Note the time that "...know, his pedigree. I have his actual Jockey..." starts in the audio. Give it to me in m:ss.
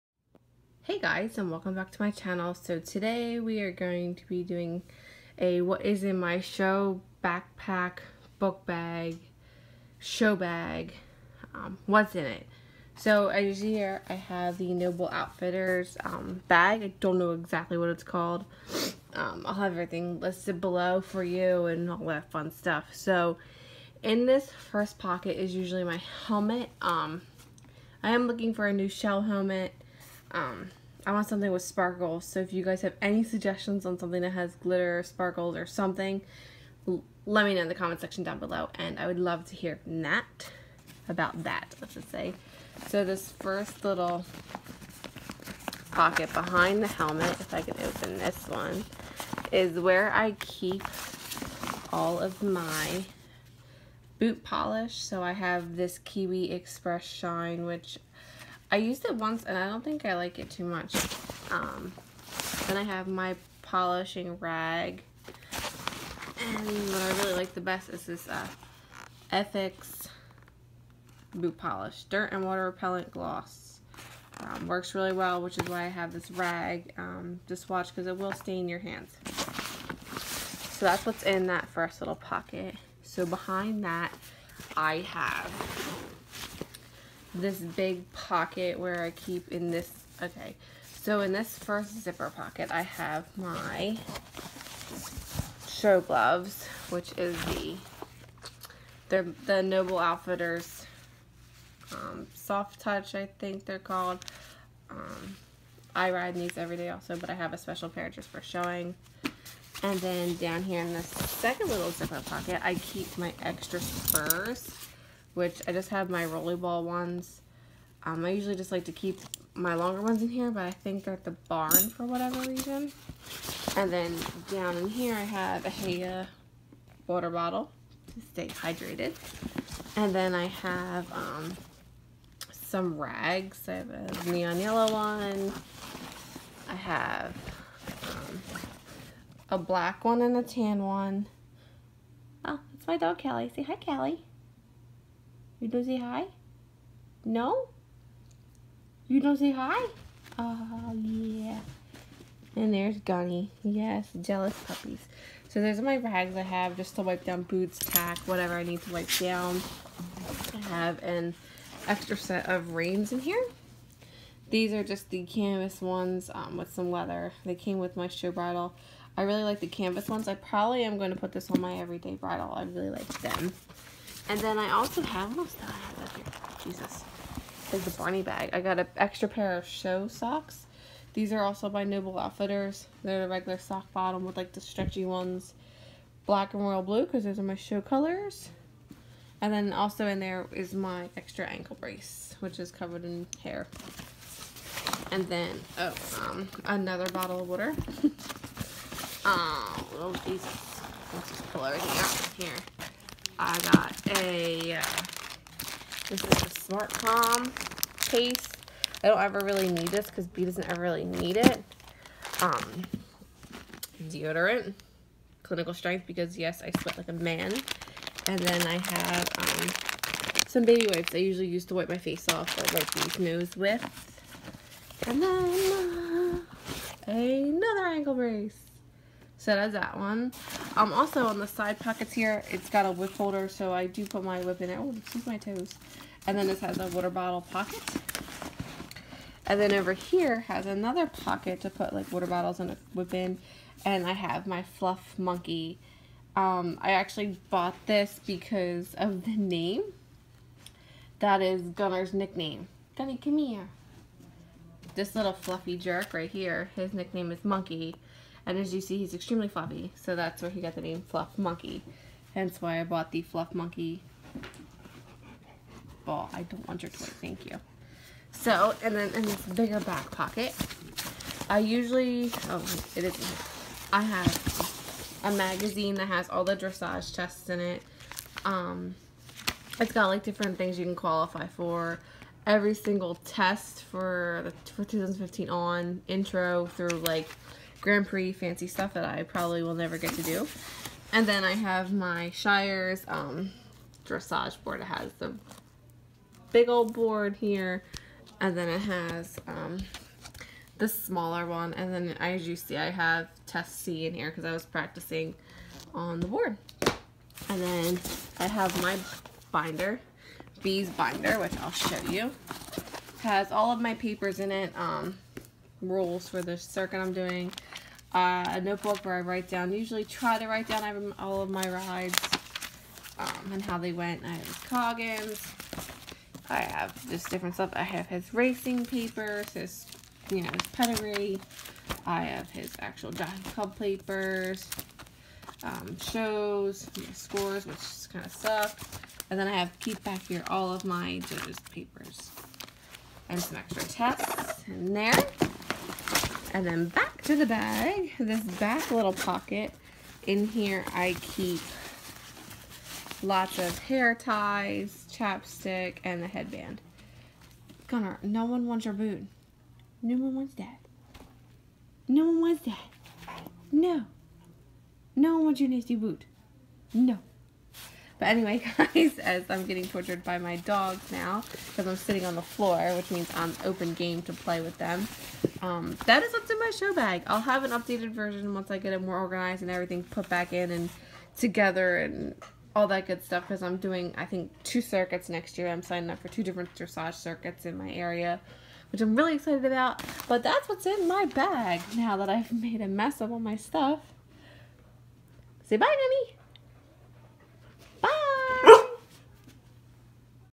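5:30.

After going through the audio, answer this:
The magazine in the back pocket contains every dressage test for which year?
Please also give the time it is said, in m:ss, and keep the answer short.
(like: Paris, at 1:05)
2015, at 4:44.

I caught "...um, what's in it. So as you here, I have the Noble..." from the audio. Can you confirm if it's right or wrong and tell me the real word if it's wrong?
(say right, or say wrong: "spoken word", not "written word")
right.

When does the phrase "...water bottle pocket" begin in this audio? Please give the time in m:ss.
3:56.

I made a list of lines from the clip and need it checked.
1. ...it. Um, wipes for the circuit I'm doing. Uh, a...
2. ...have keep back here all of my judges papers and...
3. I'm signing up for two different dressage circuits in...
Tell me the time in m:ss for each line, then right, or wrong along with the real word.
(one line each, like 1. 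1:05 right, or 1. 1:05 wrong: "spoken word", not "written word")
1. 5:14 wrong: "rules", not "wipes"
2. 5:39 right
3. 6:25 right.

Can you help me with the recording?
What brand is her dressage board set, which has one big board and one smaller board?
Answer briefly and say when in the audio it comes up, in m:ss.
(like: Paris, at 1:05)
Shires, at 4:52.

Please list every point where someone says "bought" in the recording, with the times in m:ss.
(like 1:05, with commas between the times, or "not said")
4:07, 4:22.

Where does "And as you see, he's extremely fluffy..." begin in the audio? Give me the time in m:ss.
4:18.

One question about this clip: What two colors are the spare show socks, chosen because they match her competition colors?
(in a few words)
Black and royal blue.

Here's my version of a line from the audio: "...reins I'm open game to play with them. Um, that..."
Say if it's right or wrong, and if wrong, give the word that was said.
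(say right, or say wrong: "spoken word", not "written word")
wrong: "means", not "reins".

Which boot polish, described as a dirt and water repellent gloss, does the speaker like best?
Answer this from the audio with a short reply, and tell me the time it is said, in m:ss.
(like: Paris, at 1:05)
Ethics, at 1:09.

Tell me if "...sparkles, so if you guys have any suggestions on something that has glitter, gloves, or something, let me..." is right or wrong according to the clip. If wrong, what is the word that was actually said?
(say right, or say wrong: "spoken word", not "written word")
wrong: "sparkles", not "gloves".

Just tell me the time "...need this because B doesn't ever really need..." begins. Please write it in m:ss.
3:29.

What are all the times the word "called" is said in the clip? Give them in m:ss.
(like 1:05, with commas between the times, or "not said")
0:18, 1:43.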